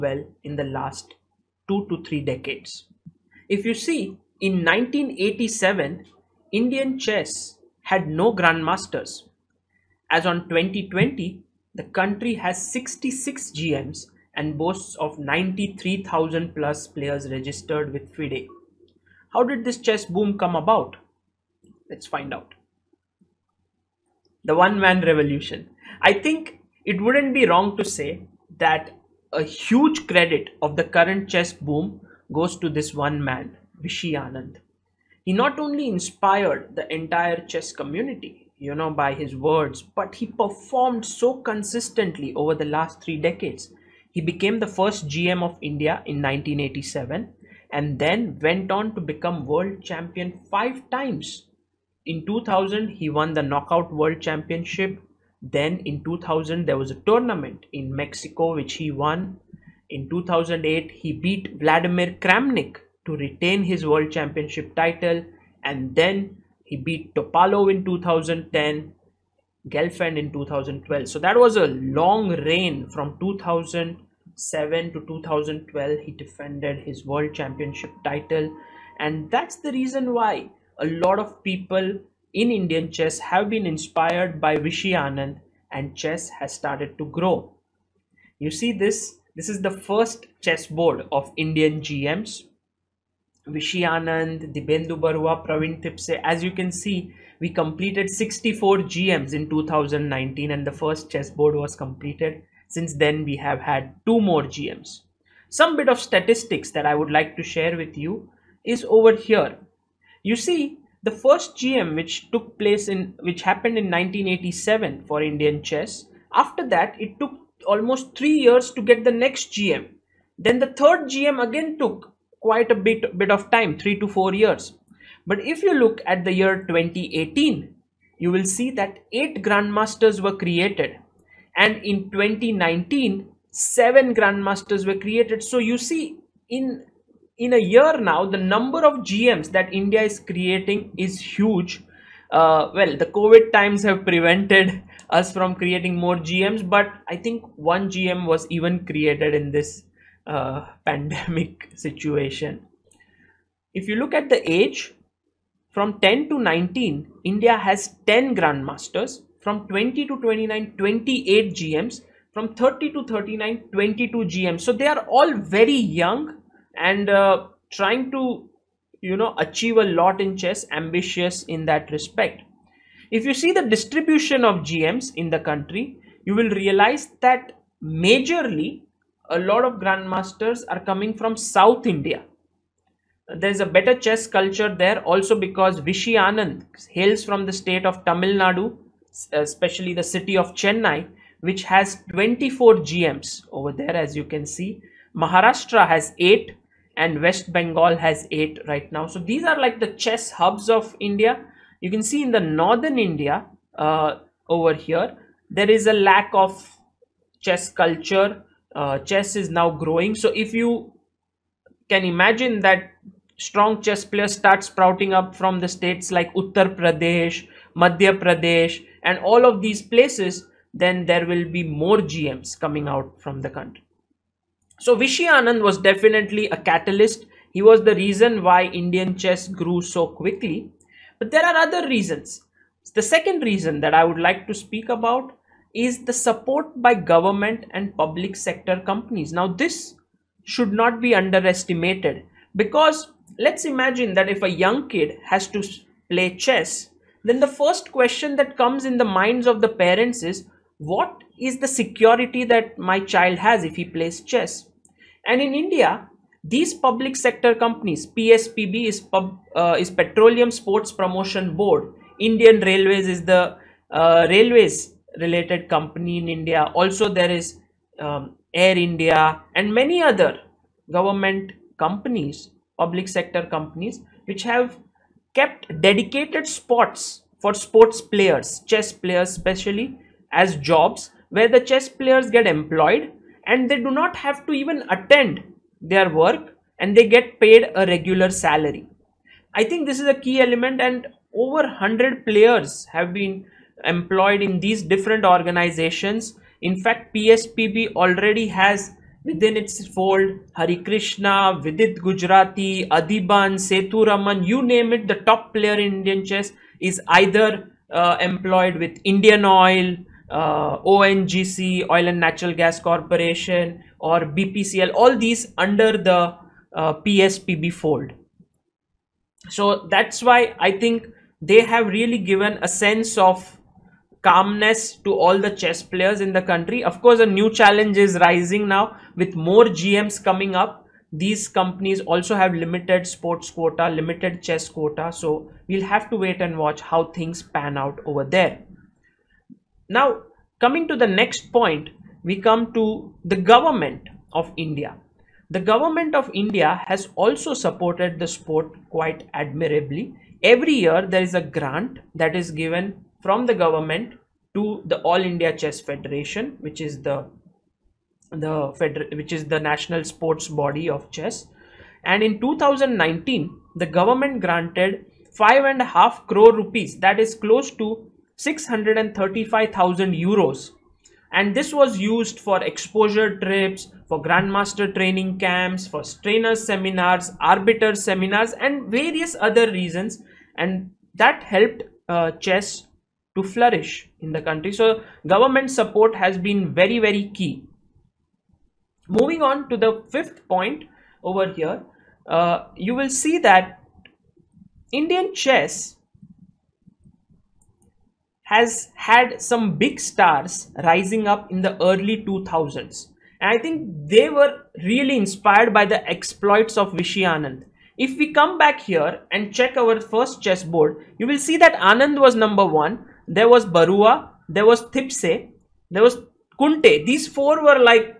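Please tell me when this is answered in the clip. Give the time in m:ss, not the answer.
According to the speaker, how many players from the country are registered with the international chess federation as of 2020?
0:15.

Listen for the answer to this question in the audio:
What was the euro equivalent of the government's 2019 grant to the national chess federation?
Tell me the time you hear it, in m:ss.
6:08.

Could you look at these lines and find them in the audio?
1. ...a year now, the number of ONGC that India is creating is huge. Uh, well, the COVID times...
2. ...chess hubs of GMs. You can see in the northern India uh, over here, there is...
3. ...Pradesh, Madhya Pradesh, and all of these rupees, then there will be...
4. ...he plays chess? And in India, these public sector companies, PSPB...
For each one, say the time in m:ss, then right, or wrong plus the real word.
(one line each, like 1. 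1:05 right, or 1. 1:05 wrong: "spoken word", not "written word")
1. 2:17 wrong: "GMs", not "ONGC"
2. 3:19 wrong: "India", not "GMs"
3. 3:36 wrong: "places", not "rupees"
4. 4:13 right.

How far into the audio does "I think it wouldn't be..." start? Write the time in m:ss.
0:26.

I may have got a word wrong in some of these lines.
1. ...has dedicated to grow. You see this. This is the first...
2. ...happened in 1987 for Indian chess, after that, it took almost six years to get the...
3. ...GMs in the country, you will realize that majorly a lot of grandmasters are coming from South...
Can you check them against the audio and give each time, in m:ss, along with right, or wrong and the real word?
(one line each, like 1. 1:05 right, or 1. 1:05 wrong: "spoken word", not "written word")
1. 1:26 wrong: "started", not "dedicated"
2. 1:53 wrong: "three", not "six"
3. 2:54 right.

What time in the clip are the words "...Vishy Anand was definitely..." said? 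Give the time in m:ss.
3:44.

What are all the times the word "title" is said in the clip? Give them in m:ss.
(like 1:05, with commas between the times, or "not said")
1:04, 1:18.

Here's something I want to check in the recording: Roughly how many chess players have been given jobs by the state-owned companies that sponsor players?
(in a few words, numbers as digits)
over 100.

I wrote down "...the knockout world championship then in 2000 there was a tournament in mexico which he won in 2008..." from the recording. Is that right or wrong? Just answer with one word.
right.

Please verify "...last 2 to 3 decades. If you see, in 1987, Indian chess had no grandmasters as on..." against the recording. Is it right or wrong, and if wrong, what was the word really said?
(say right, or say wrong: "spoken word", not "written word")
right.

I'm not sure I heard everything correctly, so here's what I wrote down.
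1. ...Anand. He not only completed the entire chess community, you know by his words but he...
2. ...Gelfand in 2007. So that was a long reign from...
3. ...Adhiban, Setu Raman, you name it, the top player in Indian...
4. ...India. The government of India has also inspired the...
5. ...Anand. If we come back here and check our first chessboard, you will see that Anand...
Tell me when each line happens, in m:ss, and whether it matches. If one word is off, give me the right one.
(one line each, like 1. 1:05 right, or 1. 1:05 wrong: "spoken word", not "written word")
1. 0:34 wrong: "inspired", not "completed"
2. 1:09 wrong: "2012", not "2007"
3. 5:02 right
4. 5:44 wrong: "supported", not "inspired"
5. 6:47 right.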